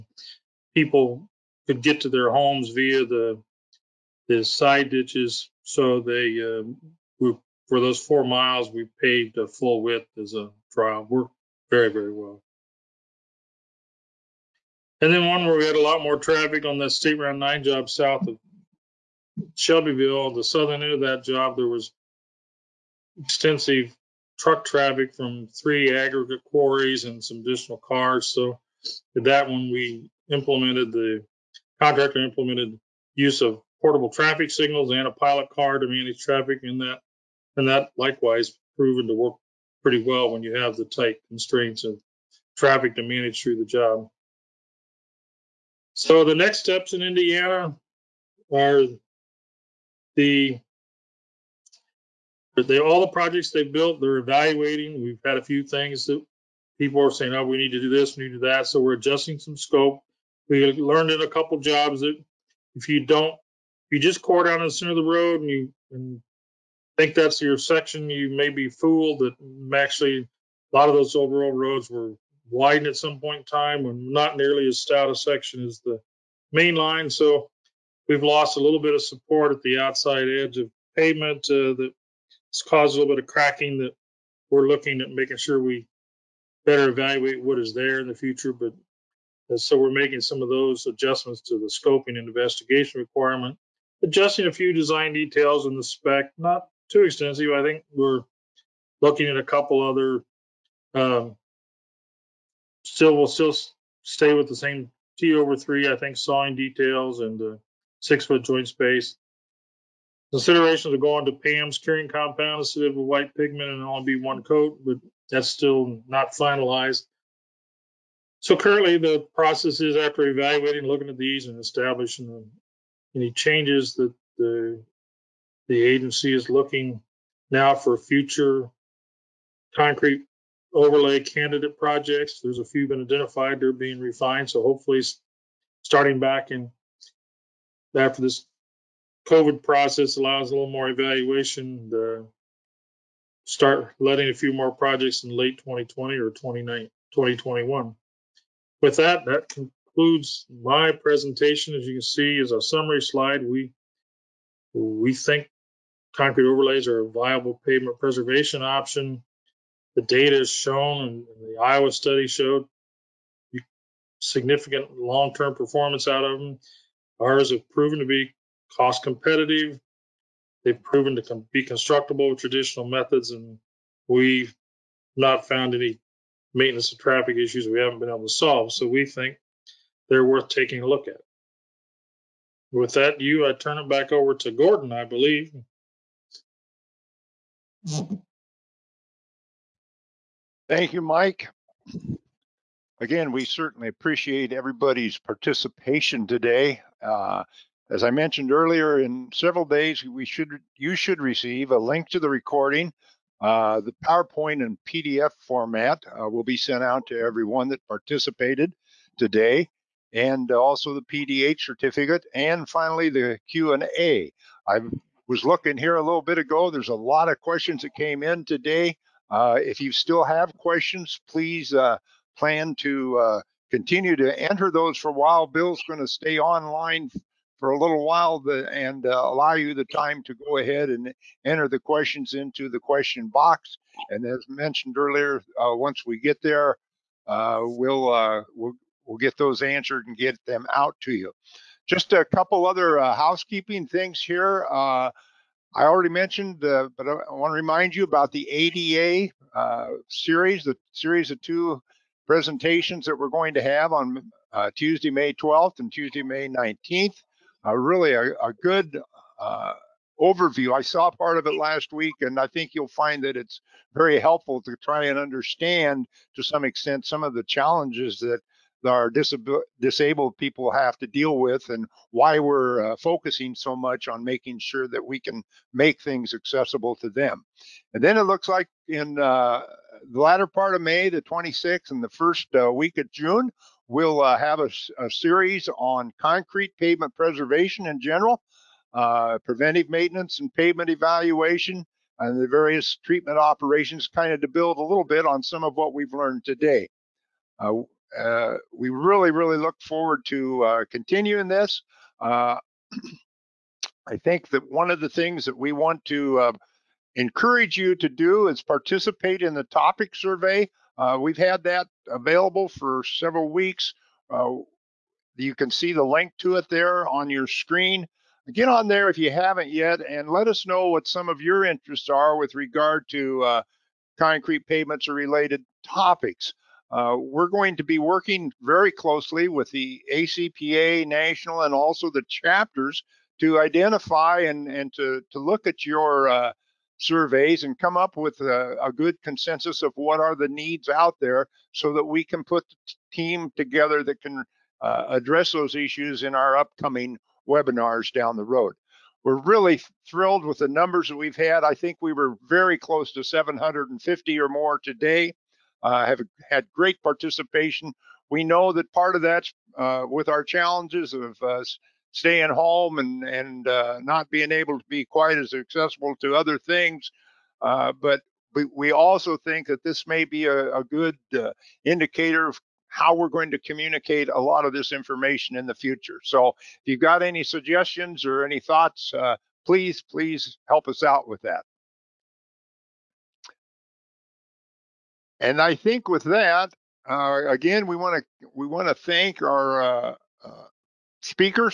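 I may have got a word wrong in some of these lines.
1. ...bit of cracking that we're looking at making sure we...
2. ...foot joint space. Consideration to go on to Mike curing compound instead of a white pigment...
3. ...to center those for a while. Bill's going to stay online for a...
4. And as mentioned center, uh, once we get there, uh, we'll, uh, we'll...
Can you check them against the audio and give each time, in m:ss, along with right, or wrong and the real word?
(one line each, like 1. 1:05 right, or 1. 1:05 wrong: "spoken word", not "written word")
1. 1:23 right
2. 1:48 wrong: "PAMS", not "Mike"
3. 3:44 wrong: "enter", not "center"
4. 3:54 wrong: "earlier", not "center".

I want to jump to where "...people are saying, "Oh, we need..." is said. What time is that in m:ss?
0:56.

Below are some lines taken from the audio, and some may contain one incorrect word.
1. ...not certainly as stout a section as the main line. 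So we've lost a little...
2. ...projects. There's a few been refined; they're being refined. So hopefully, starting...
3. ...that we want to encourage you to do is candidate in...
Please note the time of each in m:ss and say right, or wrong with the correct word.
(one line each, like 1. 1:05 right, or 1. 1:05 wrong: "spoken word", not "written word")
1. 1:14 wrong: "nearly", not "certainly"
2. 2:11 wrong: "identified", not "refined"
3. 5:05 wrong: "participate", not "candidate".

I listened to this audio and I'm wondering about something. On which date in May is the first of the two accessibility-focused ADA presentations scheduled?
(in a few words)
May 12.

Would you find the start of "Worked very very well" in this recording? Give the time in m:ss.
0:11.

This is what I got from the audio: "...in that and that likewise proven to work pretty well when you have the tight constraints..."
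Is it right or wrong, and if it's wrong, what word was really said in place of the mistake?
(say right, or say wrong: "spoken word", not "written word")
right.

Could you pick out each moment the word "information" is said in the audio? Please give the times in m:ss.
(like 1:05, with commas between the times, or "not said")
6:14.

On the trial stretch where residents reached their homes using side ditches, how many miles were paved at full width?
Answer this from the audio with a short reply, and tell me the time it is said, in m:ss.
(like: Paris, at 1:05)
4, at 0:08.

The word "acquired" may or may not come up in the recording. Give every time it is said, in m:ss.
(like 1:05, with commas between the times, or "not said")
not said.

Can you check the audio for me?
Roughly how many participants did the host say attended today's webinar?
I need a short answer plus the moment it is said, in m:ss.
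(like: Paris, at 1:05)
750, at 5:53.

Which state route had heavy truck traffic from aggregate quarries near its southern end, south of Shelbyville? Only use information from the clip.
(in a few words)
State Route 9.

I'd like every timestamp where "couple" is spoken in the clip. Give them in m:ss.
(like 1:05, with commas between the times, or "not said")
1:01, 1:39, 4:02.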